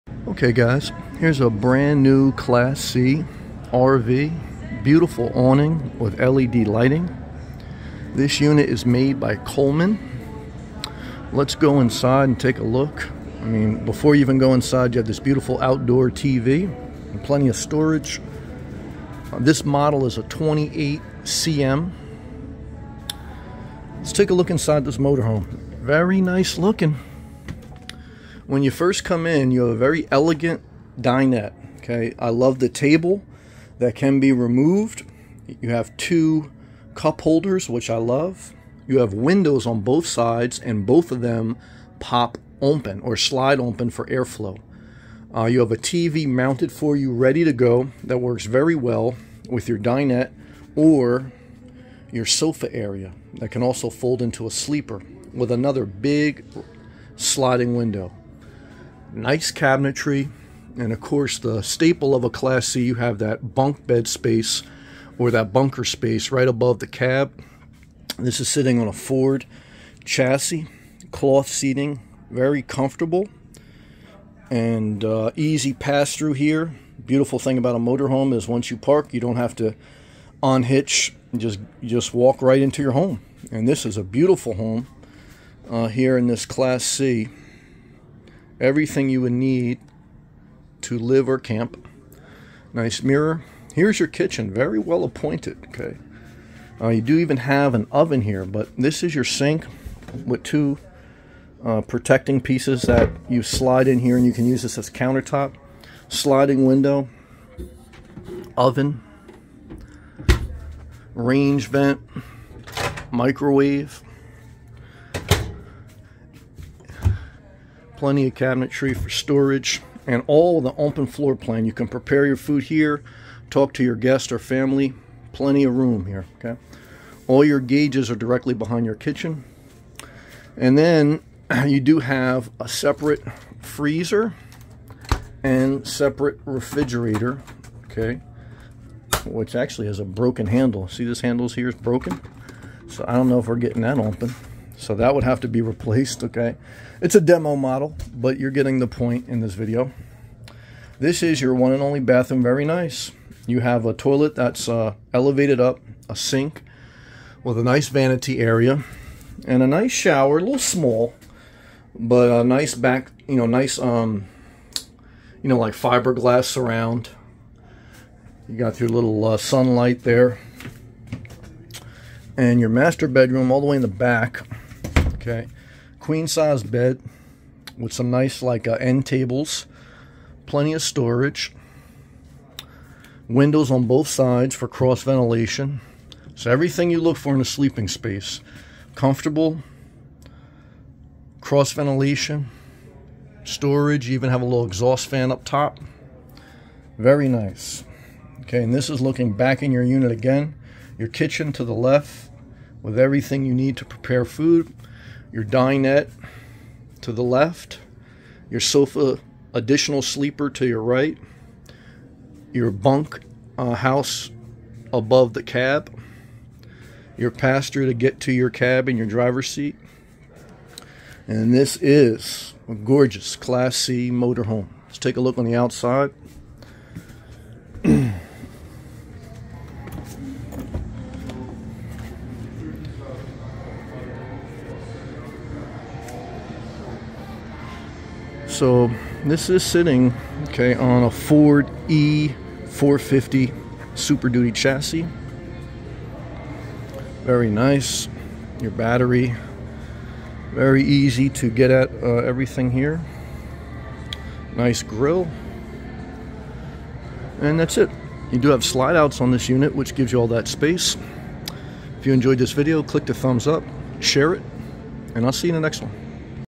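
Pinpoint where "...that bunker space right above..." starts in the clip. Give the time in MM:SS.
01:05.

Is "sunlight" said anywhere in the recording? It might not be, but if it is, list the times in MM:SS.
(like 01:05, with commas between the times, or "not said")
02:49.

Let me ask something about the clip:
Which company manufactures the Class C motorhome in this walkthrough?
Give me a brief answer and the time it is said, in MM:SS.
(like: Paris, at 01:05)
Coleman, at 00:09.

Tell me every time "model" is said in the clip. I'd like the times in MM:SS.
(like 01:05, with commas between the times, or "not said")
00:19, 02:27.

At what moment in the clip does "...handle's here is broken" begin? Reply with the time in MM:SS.
02:21.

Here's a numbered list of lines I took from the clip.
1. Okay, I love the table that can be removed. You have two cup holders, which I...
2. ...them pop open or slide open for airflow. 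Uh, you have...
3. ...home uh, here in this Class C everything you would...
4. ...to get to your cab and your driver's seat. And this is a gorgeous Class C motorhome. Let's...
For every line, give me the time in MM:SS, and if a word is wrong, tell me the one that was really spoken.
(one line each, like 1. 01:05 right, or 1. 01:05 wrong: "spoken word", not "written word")
1. 00:31 right
2. 00:41 right
3. 01:24 right
4. 03:37 right.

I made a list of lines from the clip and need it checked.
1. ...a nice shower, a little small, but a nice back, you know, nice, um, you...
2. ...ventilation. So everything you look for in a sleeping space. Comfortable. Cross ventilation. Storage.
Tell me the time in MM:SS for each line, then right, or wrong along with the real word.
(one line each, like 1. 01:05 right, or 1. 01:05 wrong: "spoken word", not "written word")
1. 02:39 right
2. 03:05 right.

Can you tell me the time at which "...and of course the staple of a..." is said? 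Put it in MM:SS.
01:00.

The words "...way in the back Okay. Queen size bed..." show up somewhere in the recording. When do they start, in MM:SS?
02:53.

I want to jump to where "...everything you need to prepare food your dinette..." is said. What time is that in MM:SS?
03:22.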